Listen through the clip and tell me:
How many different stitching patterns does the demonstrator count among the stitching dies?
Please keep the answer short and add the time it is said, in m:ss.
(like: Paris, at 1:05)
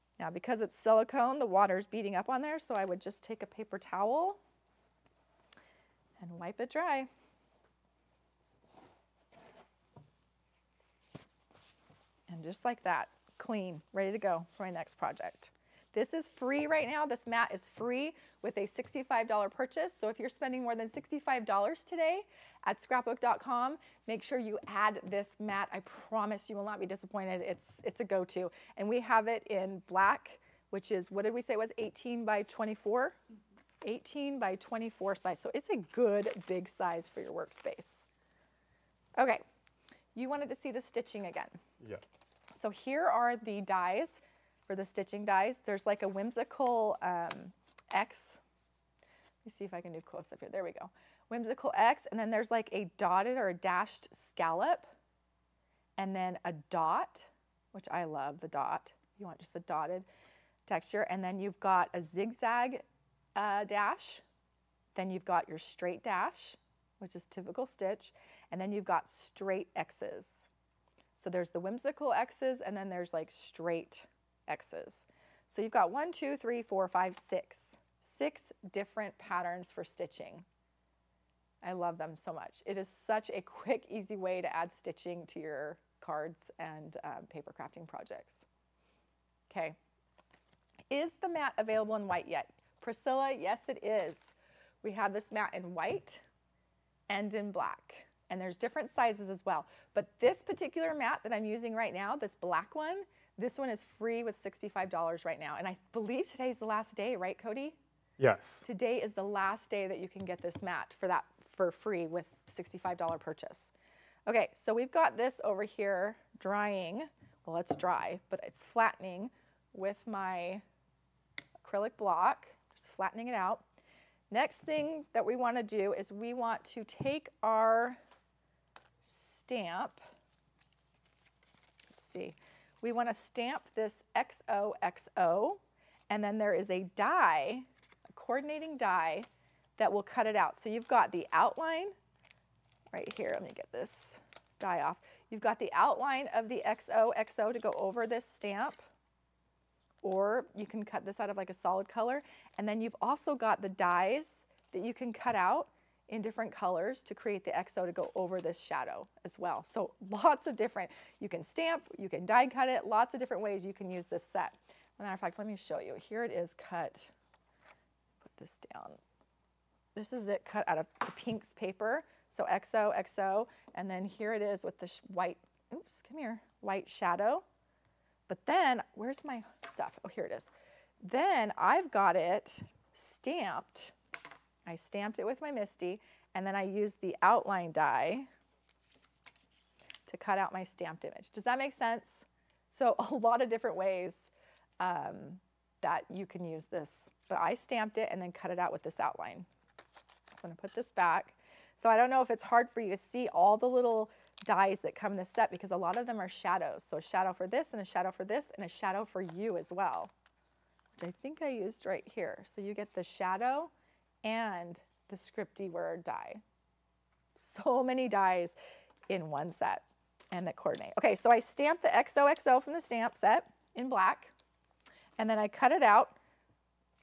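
6, at 1:18.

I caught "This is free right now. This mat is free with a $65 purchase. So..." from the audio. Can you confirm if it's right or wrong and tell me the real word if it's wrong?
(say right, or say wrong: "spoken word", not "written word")
right.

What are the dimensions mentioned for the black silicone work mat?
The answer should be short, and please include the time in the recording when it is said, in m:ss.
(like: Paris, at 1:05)
18 by 24, at 0:33.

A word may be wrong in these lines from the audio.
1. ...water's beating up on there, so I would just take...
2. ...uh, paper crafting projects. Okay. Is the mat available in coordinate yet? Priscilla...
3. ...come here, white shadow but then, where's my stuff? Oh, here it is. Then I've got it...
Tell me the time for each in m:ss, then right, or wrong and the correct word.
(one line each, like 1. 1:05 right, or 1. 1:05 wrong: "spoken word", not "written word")
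1. 0:01 right
2. 1:27 wrong: "white", not "coordinate"
3. 2:56 right.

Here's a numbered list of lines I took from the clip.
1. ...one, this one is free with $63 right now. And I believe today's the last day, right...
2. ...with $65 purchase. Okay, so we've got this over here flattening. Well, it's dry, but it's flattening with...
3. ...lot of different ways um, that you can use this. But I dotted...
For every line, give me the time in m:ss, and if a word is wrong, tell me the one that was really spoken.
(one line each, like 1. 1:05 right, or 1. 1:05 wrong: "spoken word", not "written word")
1. 1:42 wrong: "65", not "63"
2. 1:52 wrong: "drying", not "flattening"
3. 3:13 wrong: "stamped", not "dotted".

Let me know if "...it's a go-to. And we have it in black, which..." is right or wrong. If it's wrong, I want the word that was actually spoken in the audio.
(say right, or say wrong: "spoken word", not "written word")
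right.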